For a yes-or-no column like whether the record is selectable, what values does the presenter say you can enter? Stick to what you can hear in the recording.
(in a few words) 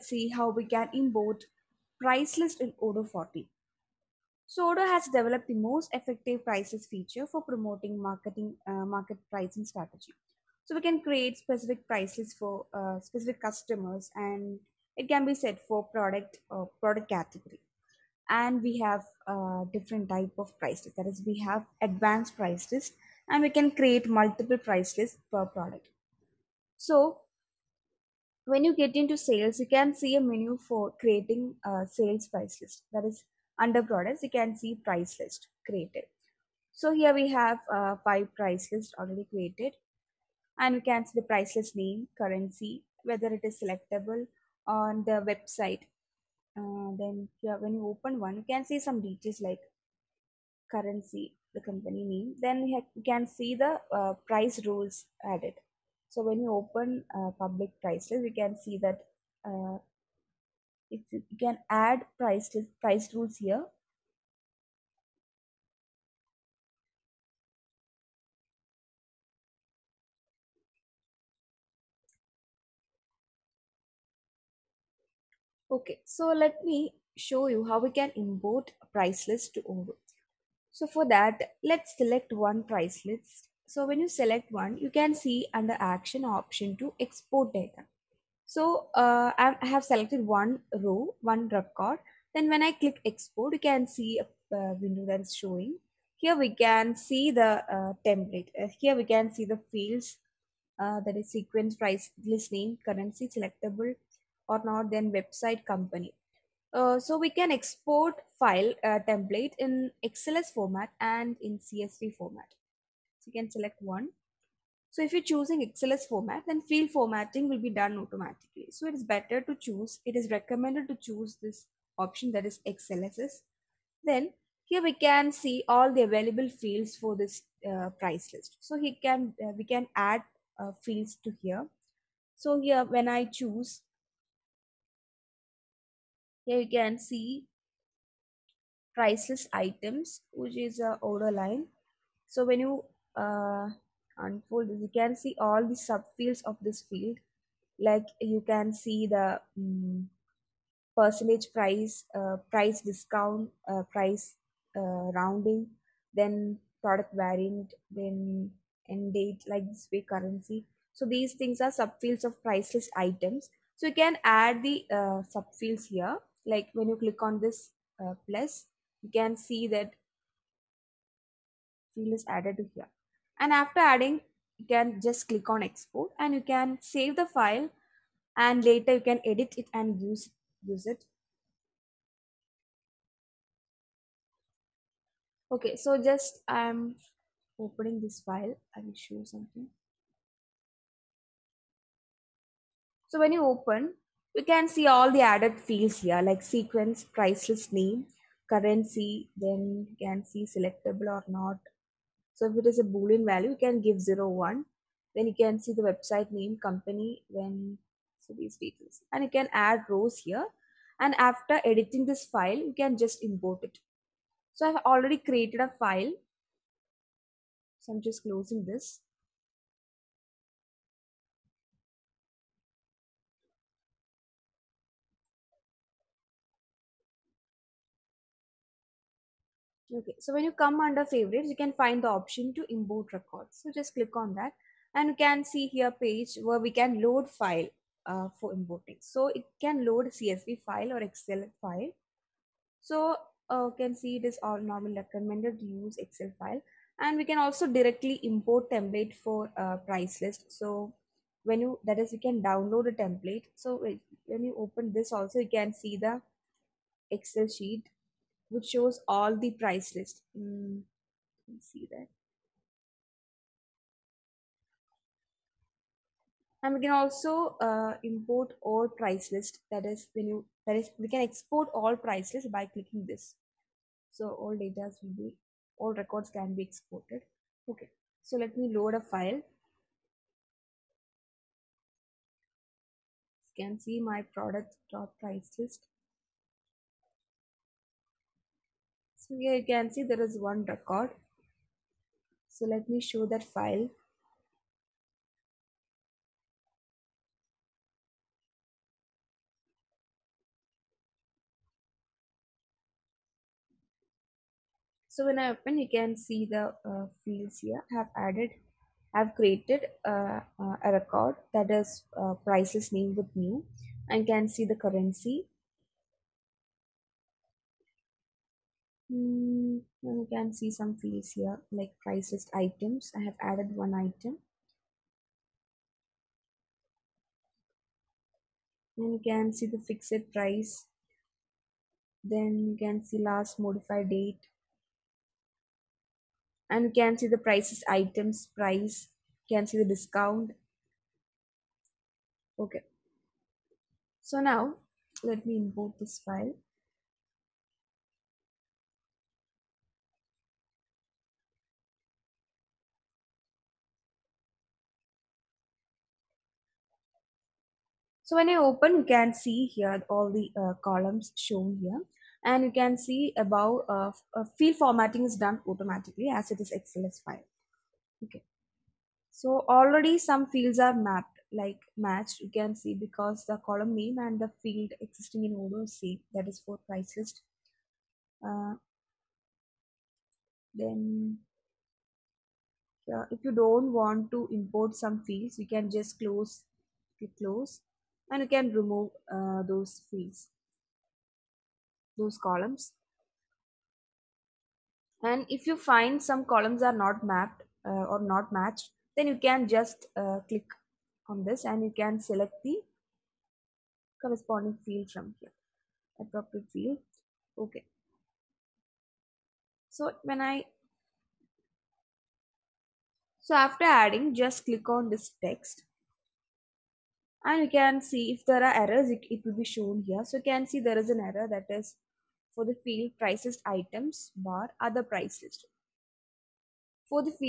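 0, 1.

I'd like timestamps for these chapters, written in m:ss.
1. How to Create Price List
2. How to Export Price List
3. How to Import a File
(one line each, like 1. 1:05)
1. 0:33
2. 1:17
3. 3:55.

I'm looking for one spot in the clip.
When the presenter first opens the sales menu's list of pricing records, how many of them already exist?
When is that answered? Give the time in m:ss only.
0:38.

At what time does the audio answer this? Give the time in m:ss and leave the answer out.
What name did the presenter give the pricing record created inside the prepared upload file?
5:13.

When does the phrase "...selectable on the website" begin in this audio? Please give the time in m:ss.
0:43.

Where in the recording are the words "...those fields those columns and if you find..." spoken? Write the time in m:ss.
6:29.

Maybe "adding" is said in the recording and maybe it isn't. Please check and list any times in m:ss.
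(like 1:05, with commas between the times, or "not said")
2:53, 6:53.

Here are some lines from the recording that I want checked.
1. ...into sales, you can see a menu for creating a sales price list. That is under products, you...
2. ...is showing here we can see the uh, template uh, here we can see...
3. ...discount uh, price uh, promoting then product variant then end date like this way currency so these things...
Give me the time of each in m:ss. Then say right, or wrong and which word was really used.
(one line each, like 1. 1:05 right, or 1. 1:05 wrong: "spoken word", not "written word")
1. 0:28 right
2. 1:35 right
3. 2:32 wrong: "rounding", not "promoting".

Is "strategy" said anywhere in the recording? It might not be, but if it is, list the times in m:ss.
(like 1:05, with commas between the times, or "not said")
0:09.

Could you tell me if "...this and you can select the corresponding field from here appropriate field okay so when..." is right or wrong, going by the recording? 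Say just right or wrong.
right.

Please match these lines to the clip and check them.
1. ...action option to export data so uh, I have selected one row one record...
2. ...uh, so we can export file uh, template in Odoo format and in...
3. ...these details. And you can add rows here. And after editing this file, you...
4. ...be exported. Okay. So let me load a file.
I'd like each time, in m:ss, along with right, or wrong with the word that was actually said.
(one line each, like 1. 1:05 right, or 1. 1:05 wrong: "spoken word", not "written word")
1. 1:25 right
2. 1:46 wrong: "XLS", not "Odoo"
3. 3:28 right
4. 4:36 right.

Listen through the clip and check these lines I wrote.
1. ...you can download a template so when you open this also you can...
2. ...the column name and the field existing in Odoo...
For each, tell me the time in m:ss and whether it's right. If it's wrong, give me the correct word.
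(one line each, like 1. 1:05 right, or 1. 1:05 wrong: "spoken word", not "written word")
1. 4:12 right
2. 6:13 right.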